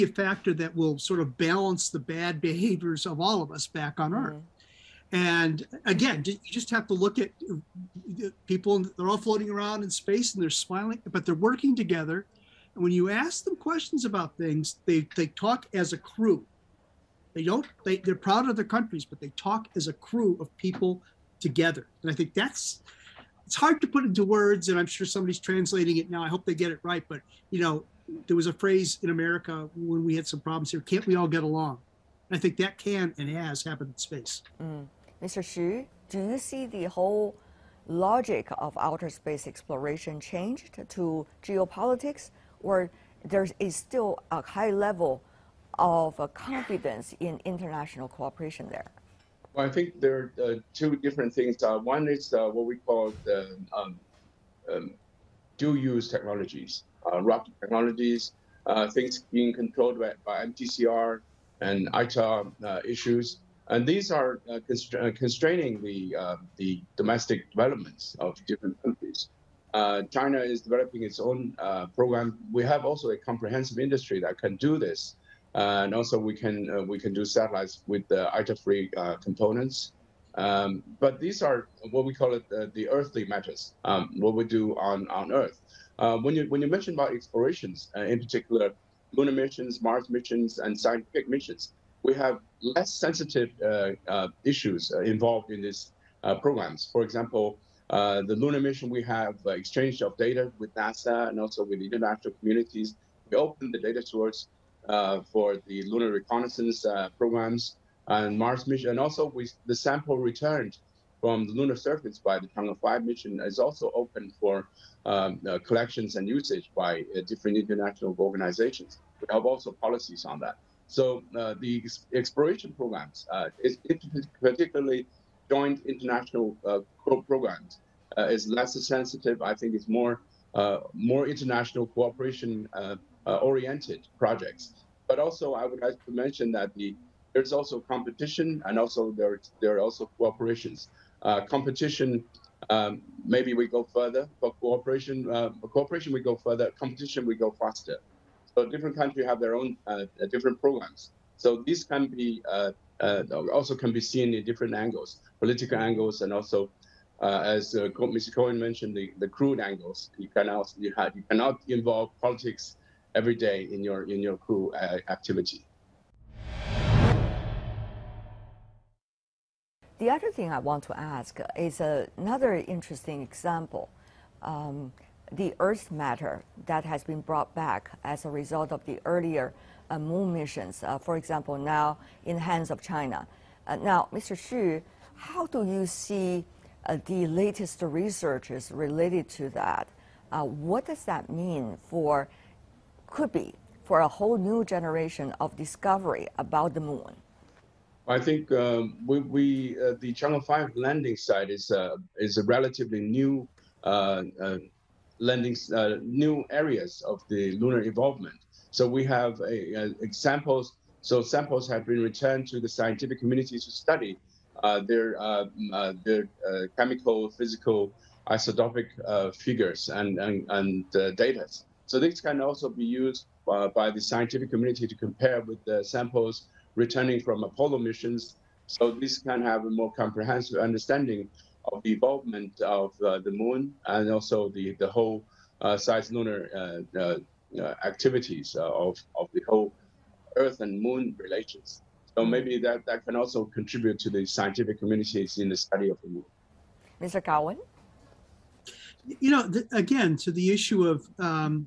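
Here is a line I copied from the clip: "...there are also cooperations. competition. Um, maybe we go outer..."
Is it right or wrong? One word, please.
wrong.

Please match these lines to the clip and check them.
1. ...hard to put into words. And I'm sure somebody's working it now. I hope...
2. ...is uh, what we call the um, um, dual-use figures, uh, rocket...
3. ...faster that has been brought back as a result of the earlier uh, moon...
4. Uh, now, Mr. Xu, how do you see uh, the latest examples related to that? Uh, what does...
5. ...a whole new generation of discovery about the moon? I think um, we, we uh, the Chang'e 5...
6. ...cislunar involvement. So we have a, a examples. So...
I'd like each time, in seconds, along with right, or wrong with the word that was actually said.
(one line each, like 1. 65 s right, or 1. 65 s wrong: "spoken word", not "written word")
1. 23 s wrong: "translating", not "working"
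2. 52 s wrong: "technologies", not "figures"
3. 175 s wrong: "matter", not "faster"
4. 183 s wrong: "researches", not "examples"
5. 193 s right
6. 207 s wrong: "lunar", not "cislunar".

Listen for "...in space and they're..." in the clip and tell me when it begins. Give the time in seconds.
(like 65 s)
9 s.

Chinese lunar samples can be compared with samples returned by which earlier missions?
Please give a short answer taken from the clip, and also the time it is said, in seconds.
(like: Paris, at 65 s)
Apollo missions, at 227 s.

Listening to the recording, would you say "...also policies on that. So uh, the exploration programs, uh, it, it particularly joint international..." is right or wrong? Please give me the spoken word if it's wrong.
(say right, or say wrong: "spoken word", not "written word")
right.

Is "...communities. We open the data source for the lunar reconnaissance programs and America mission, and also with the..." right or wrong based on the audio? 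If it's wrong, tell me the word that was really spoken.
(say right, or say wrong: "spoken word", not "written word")
wrong: "Mars", not "America".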